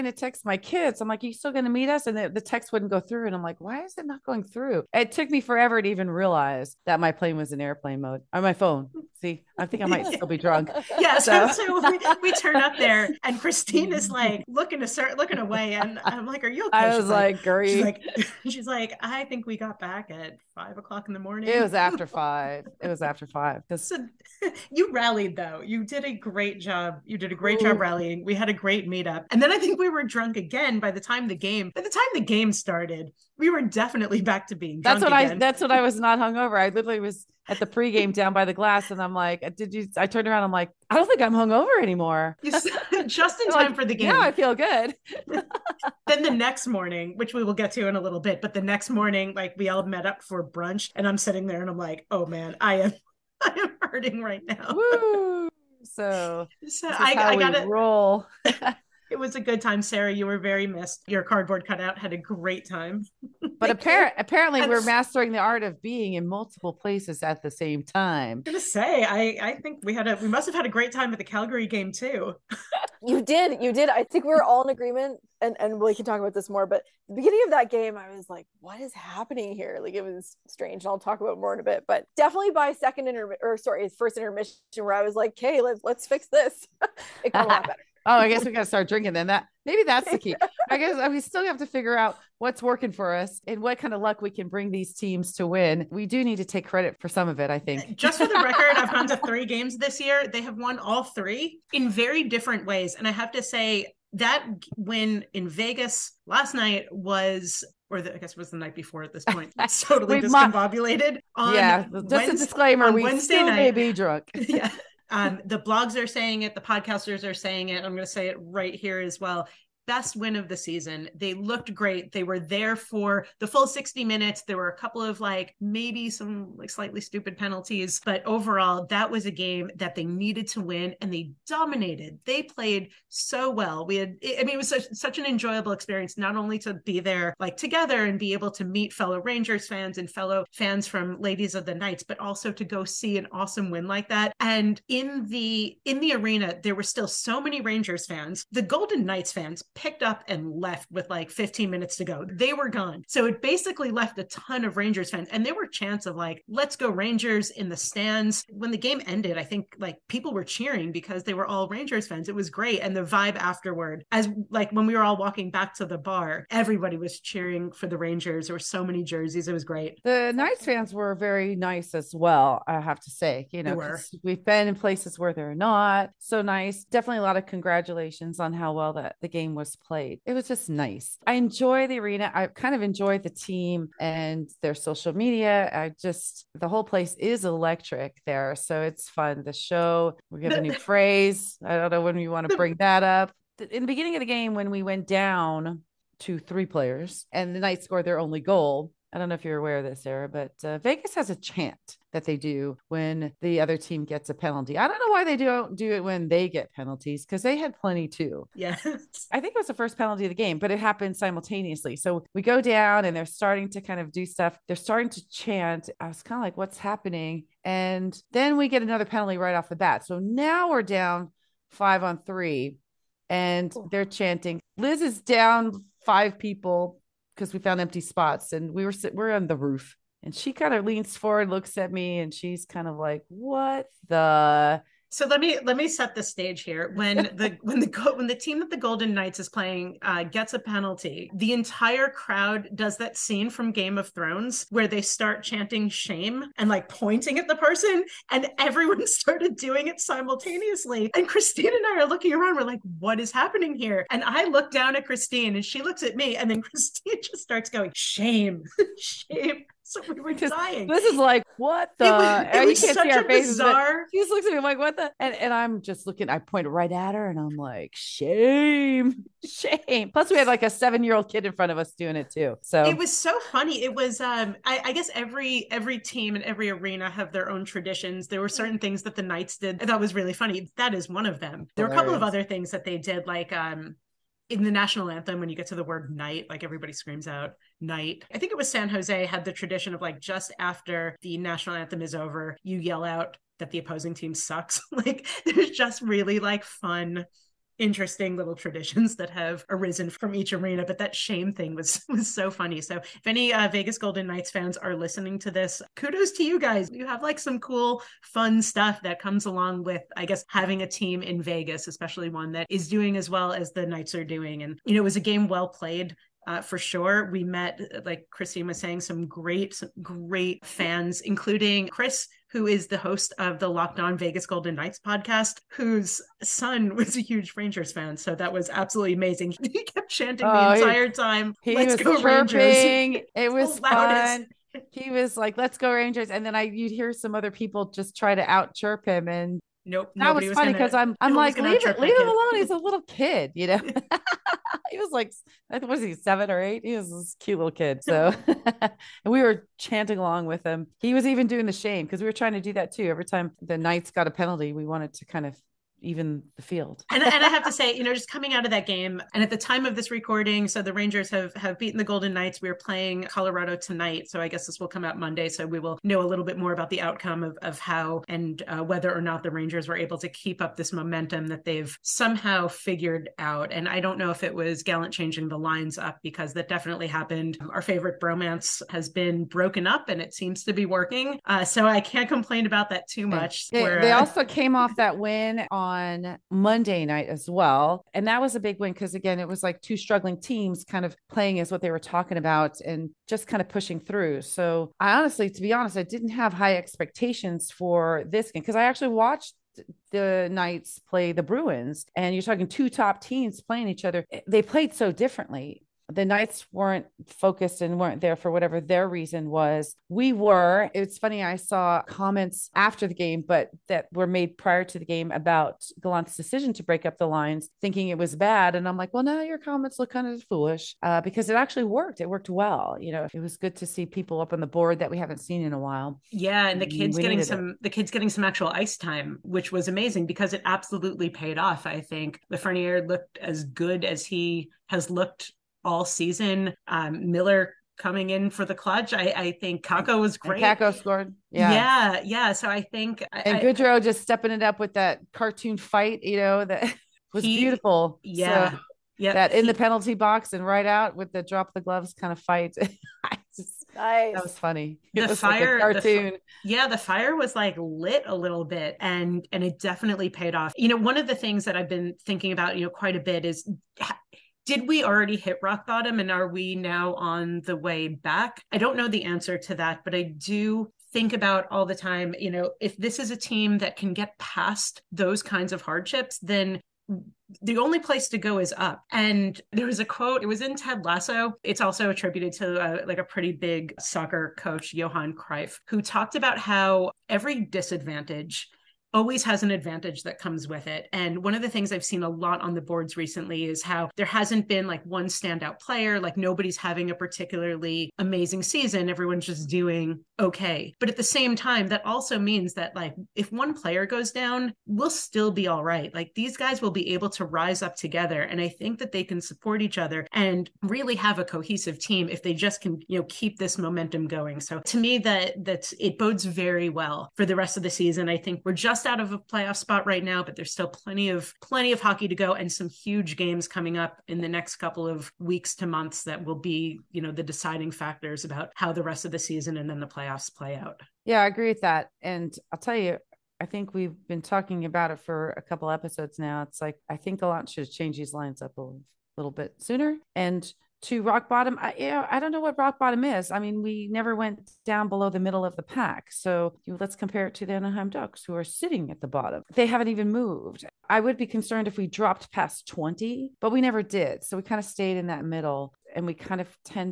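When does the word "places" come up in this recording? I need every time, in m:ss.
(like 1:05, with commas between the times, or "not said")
1:06, 2:54, 3:06, 7:57.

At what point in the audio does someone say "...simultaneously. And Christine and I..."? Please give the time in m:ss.
4:10.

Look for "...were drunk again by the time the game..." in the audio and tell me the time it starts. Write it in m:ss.
0:29.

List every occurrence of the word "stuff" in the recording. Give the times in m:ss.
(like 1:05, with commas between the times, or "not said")
3:34, 5:08.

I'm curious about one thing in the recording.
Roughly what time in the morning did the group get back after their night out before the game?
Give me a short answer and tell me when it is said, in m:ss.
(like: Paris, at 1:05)
5 o'clock, at 0:20.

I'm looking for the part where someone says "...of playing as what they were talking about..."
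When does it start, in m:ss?
6:31.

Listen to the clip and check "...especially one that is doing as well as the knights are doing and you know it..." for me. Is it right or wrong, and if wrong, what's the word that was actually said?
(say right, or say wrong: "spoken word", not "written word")
right.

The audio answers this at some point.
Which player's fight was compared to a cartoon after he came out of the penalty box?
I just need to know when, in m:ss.
7:23.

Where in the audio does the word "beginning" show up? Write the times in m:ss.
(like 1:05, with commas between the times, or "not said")
1:17, 3:13.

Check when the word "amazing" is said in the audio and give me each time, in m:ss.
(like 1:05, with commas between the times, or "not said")
5:29, 7:09, 8:18.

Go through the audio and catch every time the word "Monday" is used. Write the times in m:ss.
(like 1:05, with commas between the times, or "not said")
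6:05, 6:26.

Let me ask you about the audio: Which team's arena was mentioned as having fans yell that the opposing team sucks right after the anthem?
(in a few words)
San Jose.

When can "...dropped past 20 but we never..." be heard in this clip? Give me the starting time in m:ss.
9:12.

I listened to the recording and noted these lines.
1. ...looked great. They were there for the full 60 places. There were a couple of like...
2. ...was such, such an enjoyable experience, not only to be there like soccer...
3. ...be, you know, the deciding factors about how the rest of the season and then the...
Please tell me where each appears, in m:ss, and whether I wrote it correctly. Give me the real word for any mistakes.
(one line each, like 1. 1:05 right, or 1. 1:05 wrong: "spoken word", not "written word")
1. 2:01 wrong: "minutes", not "places"
2. 2:14 wrong: "together", not "soccer"
3. 8:46 right.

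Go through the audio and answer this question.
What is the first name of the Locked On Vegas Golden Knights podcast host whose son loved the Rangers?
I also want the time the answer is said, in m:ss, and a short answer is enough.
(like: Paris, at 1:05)
Chris, at 5:21.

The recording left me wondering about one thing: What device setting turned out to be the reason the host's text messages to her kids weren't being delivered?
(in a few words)
Airplane mode.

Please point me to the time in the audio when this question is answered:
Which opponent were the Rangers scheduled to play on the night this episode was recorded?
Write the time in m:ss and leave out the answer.
6:03.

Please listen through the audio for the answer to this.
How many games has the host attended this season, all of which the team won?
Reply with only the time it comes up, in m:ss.
1:39.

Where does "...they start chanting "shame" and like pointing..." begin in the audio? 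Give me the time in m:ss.
4:04.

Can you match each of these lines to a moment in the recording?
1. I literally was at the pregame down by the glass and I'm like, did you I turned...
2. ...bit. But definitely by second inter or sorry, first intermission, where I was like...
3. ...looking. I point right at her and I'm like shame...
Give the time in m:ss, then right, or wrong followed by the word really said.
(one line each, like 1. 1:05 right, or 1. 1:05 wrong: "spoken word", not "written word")
1. 0:36 right
2. 1:21 right
3. 4:26 right.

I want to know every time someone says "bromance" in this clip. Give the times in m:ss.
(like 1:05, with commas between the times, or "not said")
6:18.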